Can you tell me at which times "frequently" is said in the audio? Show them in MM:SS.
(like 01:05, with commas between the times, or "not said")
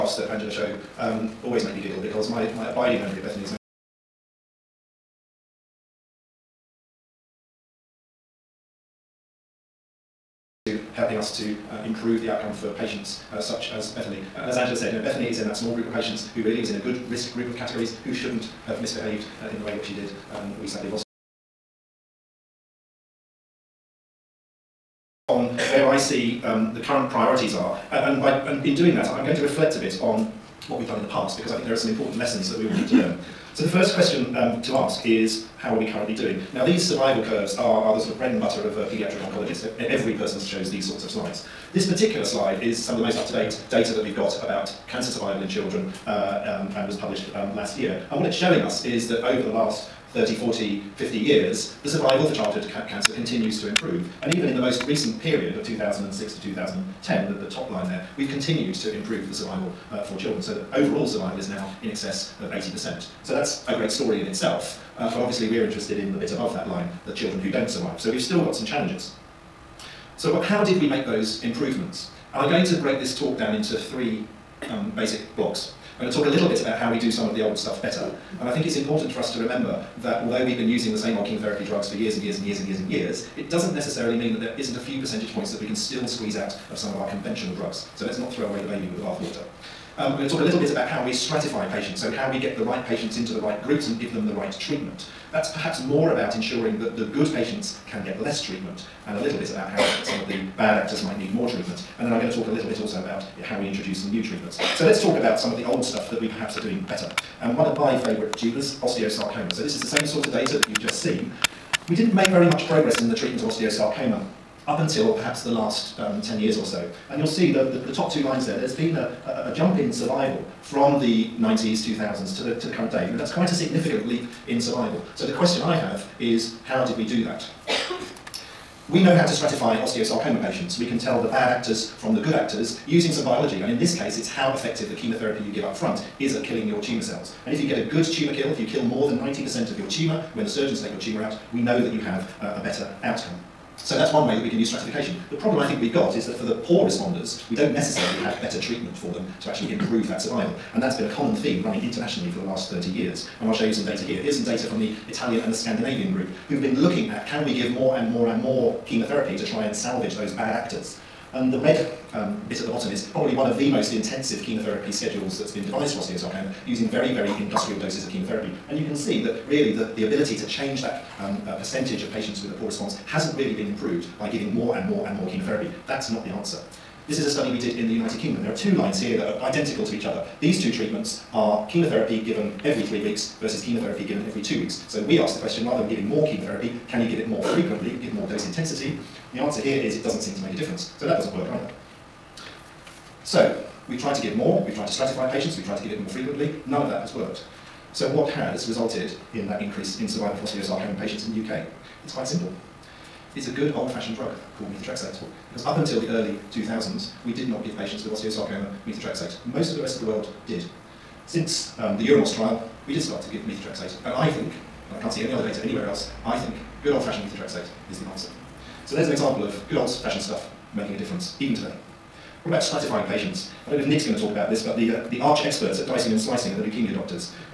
03:07, 03:16.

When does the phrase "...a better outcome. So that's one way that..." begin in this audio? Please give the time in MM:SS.
02:22.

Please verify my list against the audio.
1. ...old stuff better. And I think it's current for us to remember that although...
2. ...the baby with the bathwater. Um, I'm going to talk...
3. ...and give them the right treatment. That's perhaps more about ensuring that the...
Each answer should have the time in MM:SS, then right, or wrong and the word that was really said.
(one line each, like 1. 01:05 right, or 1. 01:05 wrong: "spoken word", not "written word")
1. 01:17 wrong: "important", not "current"
2. 01:28 right
3. 01:33 right.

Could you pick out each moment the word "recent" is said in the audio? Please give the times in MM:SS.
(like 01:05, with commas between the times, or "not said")
00:54.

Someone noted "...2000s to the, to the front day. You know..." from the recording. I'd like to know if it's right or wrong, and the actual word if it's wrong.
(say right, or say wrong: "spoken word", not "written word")
wrong: "current", not "front".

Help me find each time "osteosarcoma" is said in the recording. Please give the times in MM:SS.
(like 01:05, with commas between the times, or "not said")
01:48, 01:53, 02:09, 02:45, 03:20, 03:28.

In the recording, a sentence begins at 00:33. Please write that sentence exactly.
So the first question um, to ask is, how are we currently doing?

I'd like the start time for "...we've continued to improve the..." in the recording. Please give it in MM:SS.
00:58.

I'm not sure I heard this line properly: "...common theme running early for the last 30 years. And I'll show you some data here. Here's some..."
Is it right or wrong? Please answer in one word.
wrong.